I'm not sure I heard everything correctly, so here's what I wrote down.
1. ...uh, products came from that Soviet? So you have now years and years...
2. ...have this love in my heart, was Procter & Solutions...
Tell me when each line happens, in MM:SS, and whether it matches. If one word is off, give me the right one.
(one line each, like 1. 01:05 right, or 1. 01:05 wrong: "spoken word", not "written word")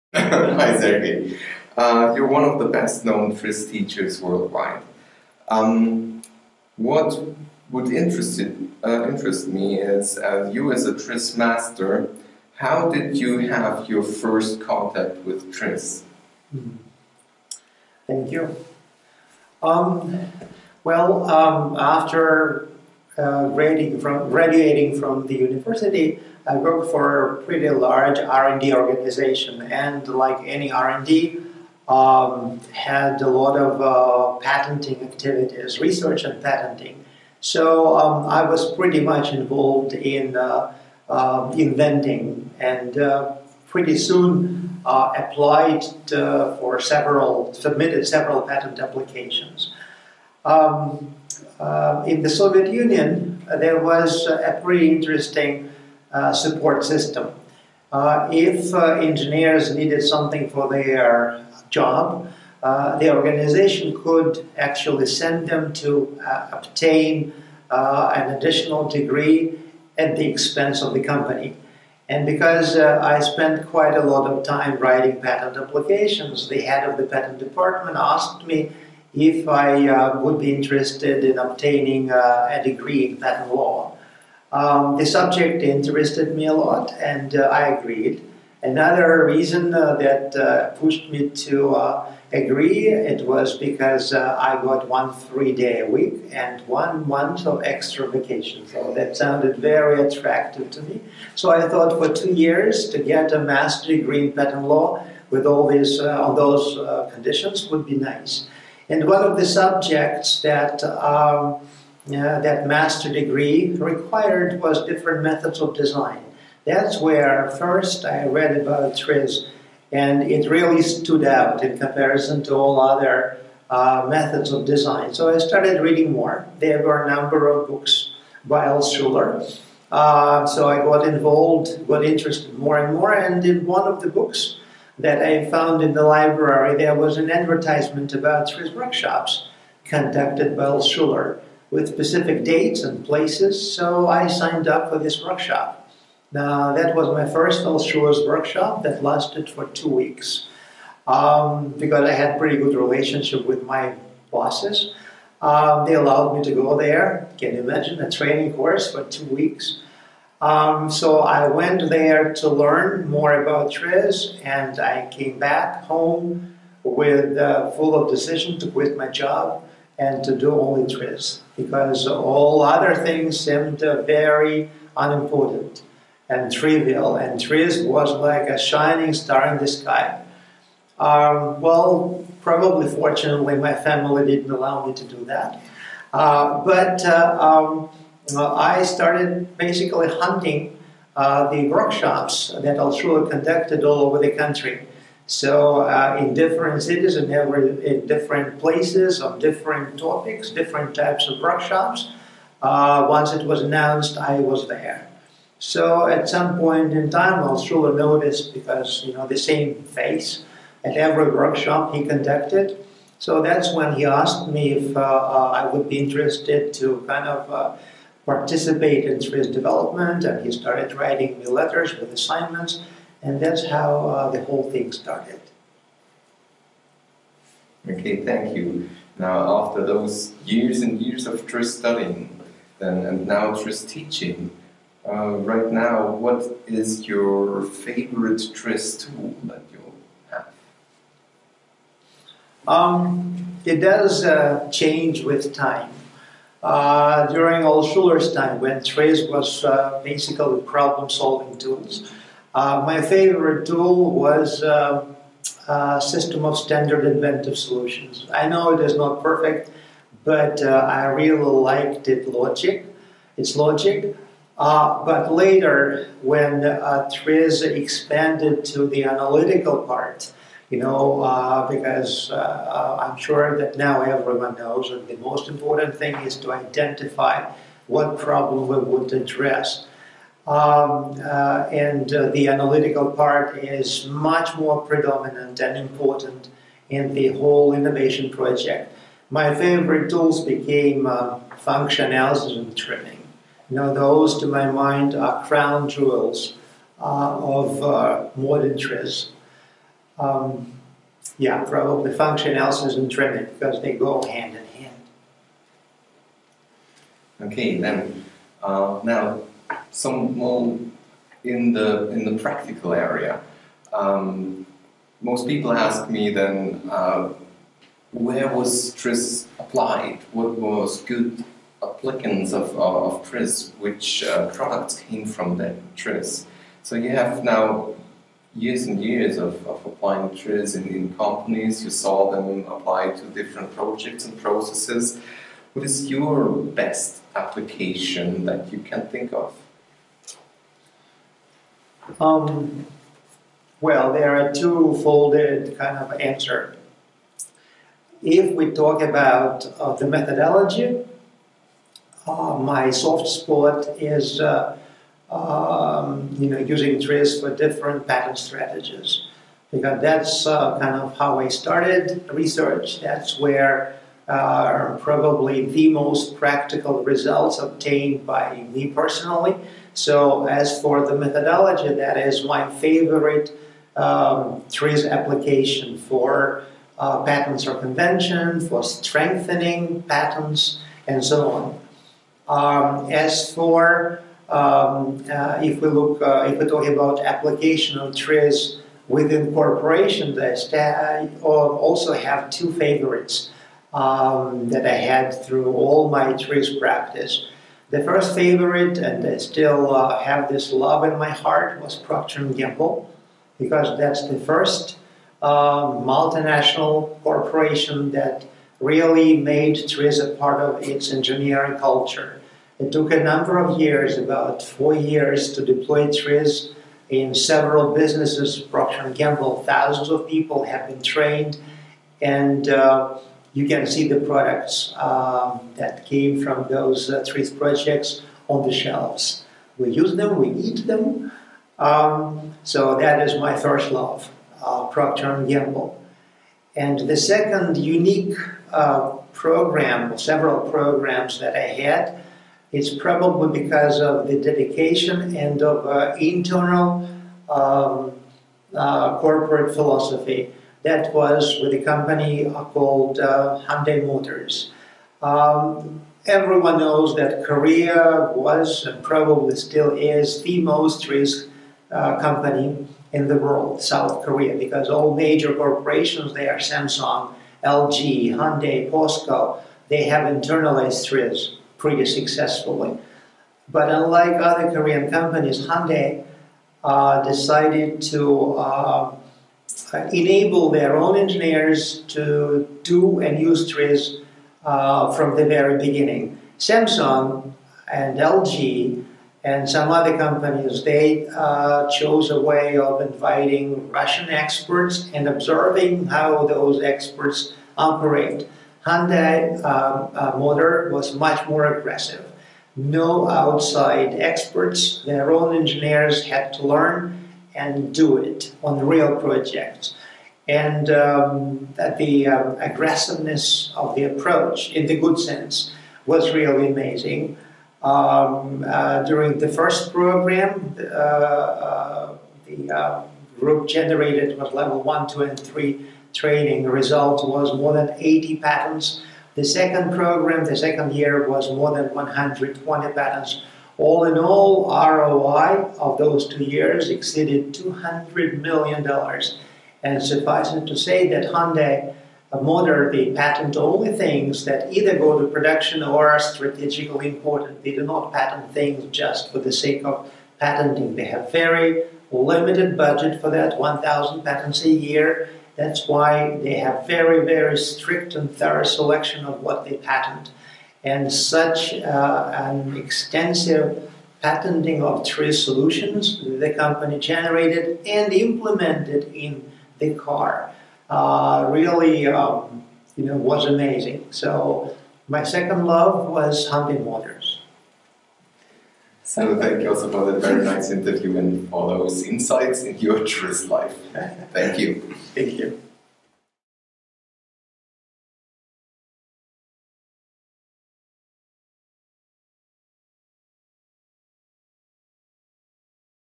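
1. 05:24 wrong: "TRIZ", not "Soviet"
2. 06:40 wrong: "Gamble", not "Solutions".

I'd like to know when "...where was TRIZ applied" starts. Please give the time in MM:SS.
05:18.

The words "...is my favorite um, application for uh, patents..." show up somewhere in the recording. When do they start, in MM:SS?
06:12.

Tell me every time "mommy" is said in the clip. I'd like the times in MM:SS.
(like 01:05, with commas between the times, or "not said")
not said.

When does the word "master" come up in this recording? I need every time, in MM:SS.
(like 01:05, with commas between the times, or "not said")
00:11, 01:43, 01:52.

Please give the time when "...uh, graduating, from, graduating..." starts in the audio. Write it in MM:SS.
00:23.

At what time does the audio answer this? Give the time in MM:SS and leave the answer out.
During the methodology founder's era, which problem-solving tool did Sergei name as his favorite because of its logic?
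04:16.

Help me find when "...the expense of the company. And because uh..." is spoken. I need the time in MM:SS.
01:10.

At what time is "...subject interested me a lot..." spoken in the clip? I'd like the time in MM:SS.
01:25.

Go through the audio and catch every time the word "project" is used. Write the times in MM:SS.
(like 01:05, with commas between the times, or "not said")
04:48, 05:33, 07:07, 08:29.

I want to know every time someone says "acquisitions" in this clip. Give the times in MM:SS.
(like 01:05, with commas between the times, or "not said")
not said.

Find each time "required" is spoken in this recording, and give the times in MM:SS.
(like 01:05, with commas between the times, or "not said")
01:53.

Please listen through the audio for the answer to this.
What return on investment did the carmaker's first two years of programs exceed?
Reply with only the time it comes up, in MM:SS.
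08:57.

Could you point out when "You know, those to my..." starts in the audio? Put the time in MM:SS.
04:53.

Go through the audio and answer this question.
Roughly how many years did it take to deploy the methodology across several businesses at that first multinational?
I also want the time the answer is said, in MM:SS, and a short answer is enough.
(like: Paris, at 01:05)
about four years, at 06:54.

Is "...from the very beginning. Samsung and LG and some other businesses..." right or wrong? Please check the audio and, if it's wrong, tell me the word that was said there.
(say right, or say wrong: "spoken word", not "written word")
wrong: "companies", not "businesses".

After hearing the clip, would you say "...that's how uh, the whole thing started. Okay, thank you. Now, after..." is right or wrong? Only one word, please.
right.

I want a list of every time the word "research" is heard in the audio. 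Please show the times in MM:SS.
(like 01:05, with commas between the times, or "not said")
00:35, 06:02.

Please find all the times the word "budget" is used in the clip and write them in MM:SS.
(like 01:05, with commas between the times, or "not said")
09:12.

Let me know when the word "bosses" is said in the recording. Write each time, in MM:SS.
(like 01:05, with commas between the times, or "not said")
02:34.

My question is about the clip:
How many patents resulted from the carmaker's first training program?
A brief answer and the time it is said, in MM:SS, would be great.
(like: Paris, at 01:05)
more than 80, at 08:47.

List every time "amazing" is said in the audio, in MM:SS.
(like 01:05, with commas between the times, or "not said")
08:36, 09:33.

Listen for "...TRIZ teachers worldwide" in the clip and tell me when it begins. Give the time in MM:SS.
00:03.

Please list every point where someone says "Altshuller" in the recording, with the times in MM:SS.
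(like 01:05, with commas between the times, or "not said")
02:08, 02:20, 02:27, 03:12, 03:27, 04:07.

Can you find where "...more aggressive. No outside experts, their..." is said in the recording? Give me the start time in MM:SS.
08:21.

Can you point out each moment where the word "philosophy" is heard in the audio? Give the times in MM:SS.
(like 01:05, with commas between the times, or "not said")
07:29.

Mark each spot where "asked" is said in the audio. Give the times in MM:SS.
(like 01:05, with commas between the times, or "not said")
01:17, 03:34.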